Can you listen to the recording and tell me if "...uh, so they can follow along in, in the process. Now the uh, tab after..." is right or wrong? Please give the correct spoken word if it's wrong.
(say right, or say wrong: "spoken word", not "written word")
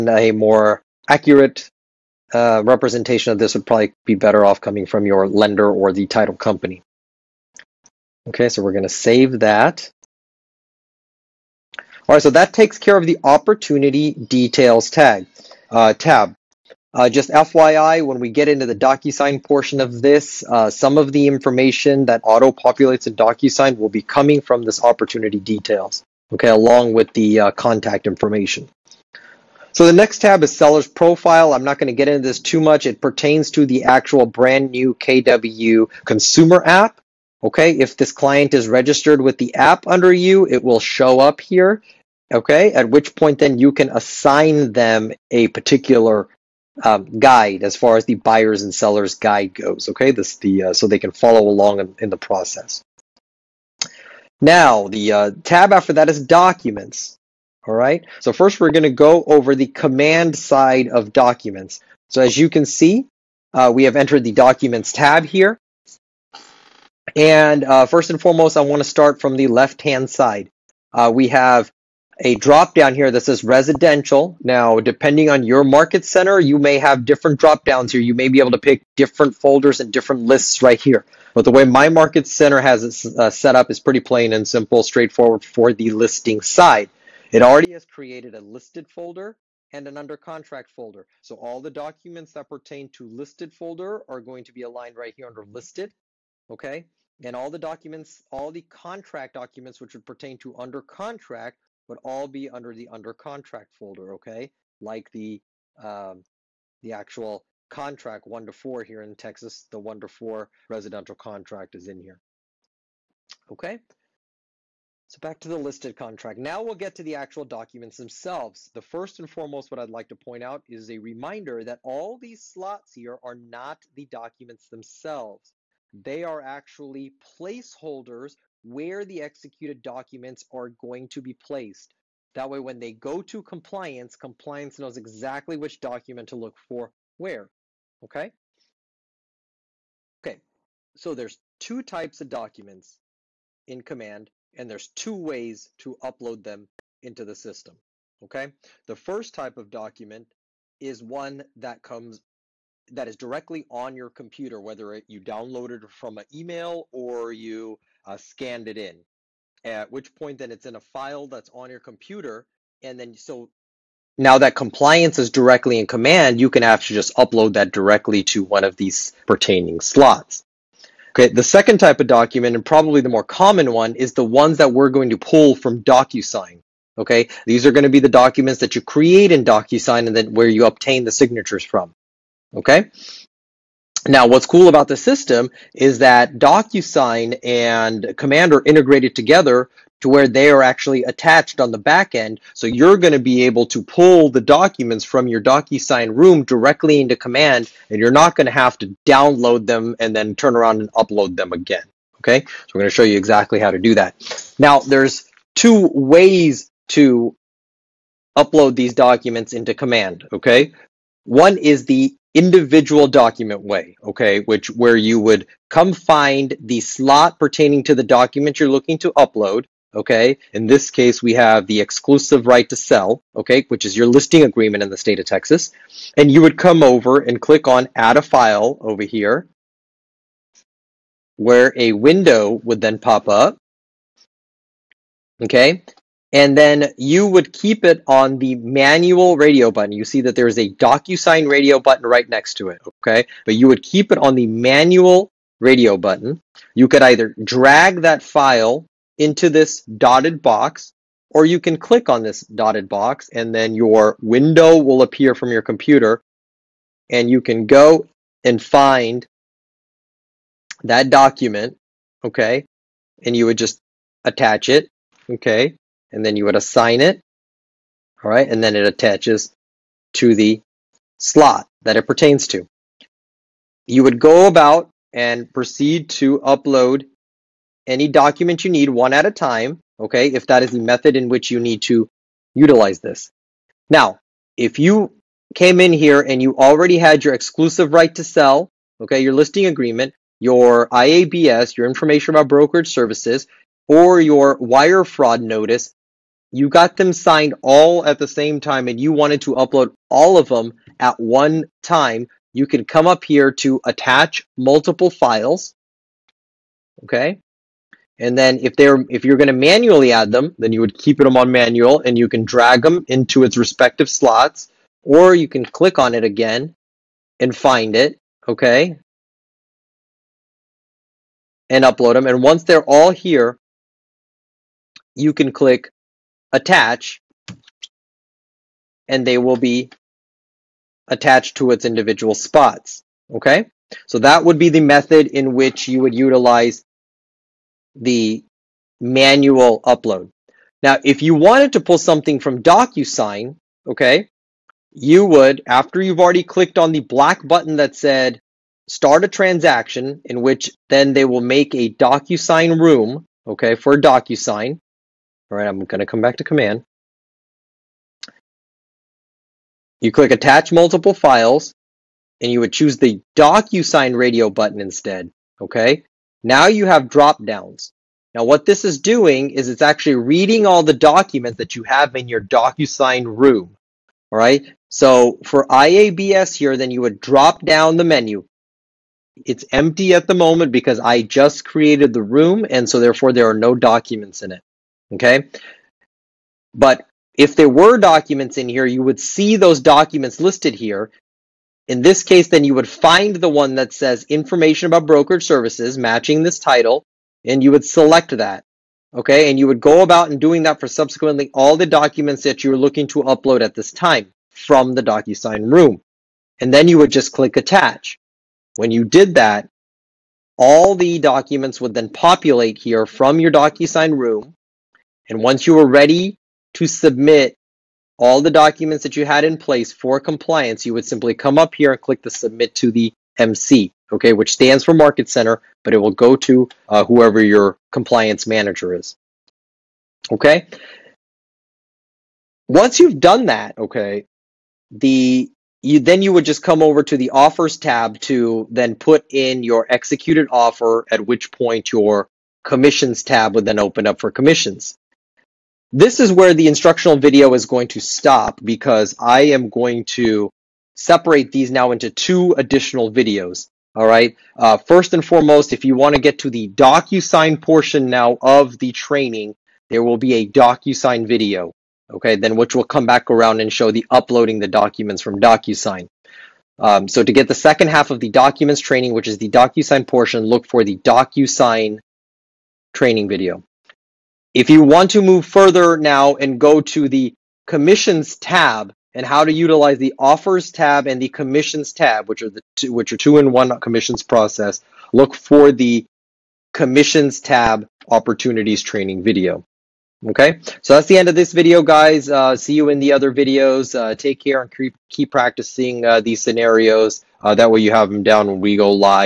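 right.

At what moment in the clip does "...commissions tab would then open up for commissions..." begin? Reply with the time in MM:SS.
07:22.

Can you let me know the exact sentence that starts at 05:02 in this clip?
You can come up here to attach multiple files.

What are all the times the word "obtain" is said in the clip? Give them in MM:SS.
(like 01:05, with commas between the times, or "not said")
03:00.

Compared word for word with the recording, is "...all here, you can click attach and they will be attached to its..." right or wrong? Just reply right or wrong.
right.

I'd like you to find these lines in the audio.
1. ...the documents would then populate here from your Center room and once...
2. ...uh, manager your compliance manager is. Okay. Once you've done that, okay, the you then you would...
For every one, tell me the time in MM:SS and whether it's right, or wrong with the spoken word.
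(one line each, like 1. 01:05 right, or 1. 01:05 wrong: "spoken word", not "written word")
1. 06:50 wrong: "DocuSign", not "Center"
2. 07:06 wrong: "whoever", not "manager".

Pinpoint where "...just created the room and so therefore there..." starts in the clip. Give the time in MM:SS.
06:21.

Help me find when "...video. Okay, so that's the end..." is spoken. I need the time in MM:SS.
08:09.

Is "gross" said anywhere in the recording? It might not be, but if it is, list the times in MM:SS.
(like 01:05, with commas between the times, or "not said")
not said.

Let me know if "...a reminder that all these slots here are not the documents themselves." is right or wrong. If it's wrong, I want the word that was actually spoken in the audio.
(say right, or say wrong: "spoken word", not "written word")
right.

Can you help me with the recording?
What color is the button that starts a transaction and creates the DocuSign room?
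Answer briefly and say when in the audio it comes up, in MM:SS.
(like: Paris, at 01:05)
Black, at 05:46.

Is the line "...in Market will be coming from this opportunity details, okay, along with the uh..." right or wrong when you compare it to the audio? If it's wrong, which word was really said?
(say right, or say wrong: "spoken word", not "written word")
wrong: "DocuSign", not "Market".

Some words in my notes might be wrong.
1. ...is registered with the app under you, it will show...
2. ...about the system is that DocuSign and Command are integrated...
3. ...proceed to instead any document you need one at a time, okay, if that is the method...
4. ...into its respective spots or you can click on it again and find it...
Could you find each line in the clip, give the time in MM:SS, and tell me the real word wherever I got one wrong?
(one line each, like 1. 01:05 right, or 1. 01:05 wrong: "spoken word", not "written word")
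1. 00:38 right
2. 03:04 right
3. 04:35 wrong: "upload", not "instead"
4. 05:13 wrong: "slots", not "spots".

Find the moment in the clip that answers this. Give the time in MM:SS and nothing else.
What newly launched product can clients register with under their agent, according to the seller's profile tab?
00:34.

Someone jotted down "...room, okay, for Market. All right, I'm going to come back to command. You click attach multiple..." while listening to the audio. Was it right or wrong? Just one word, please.
wrong.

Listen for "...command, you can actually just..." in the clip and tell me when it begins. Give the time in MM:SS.
02:45.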